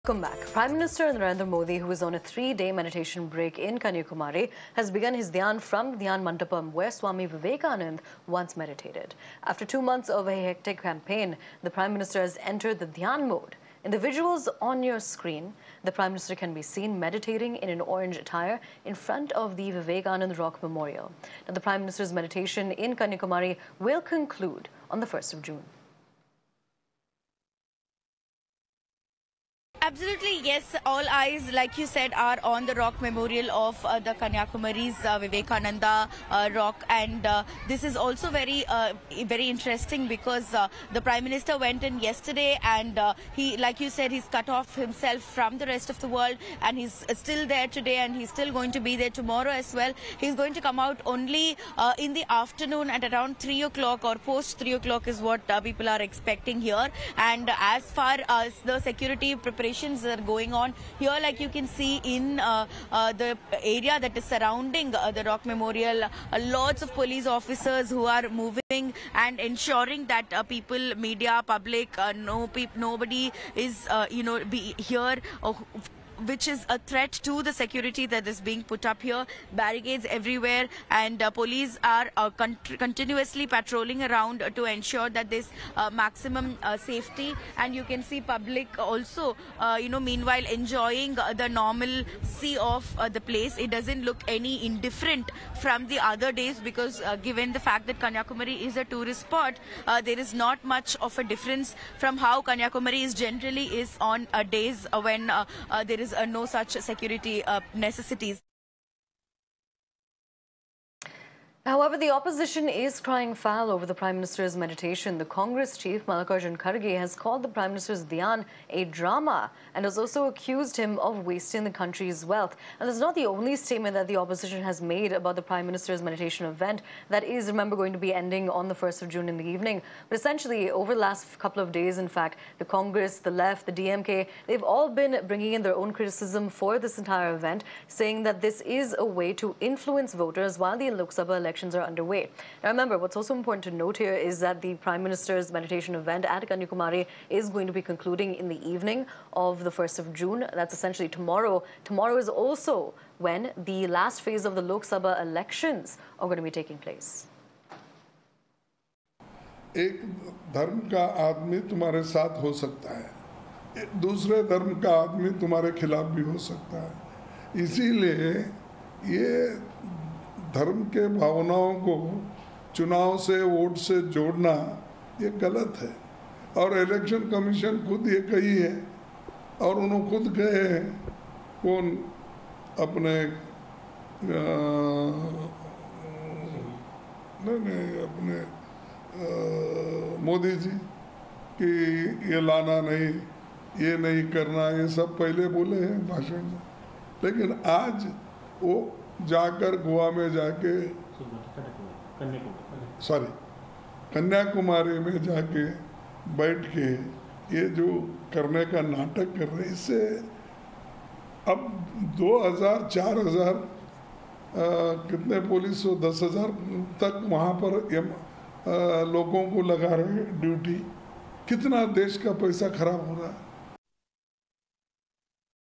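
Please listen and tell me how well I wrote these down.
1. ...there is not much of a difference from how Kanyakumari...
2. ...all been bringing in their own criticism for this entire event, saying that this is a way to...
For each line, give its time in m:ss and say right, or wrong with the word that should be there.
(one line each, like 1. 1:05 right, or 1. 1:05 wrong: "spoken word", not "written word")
1. 1:40 right
2. 2:14 right.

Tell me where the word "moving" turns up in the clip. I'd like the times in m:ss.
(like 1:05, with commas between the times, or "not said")
1:08.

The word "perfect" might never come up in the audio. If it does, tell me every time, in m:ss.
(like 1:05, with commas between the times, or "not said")
not said.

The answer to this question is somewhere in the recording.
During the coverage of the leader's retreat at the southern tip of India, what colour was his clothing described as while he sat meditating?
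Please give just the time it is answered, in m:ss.
0:17.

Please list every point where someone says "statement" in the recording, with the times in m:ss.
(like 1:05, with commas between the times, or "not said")
2:03.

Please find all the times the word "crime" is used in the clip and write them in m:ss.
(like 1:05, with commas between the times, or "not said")
not said.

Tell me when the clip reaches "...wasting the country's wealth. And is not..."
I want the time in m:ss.
2:01.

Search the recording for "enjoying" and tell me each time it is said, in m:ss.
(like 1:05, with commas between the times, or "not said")
1:30.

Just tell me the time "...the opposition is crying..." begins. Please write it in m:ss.
1:51.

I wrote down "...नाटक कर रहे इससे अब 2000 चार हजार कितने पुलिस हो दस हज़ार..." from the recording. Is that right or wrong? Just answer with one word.
right.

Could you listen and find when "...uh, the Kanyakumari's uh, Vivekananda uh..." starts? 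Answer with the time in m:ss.
0:33.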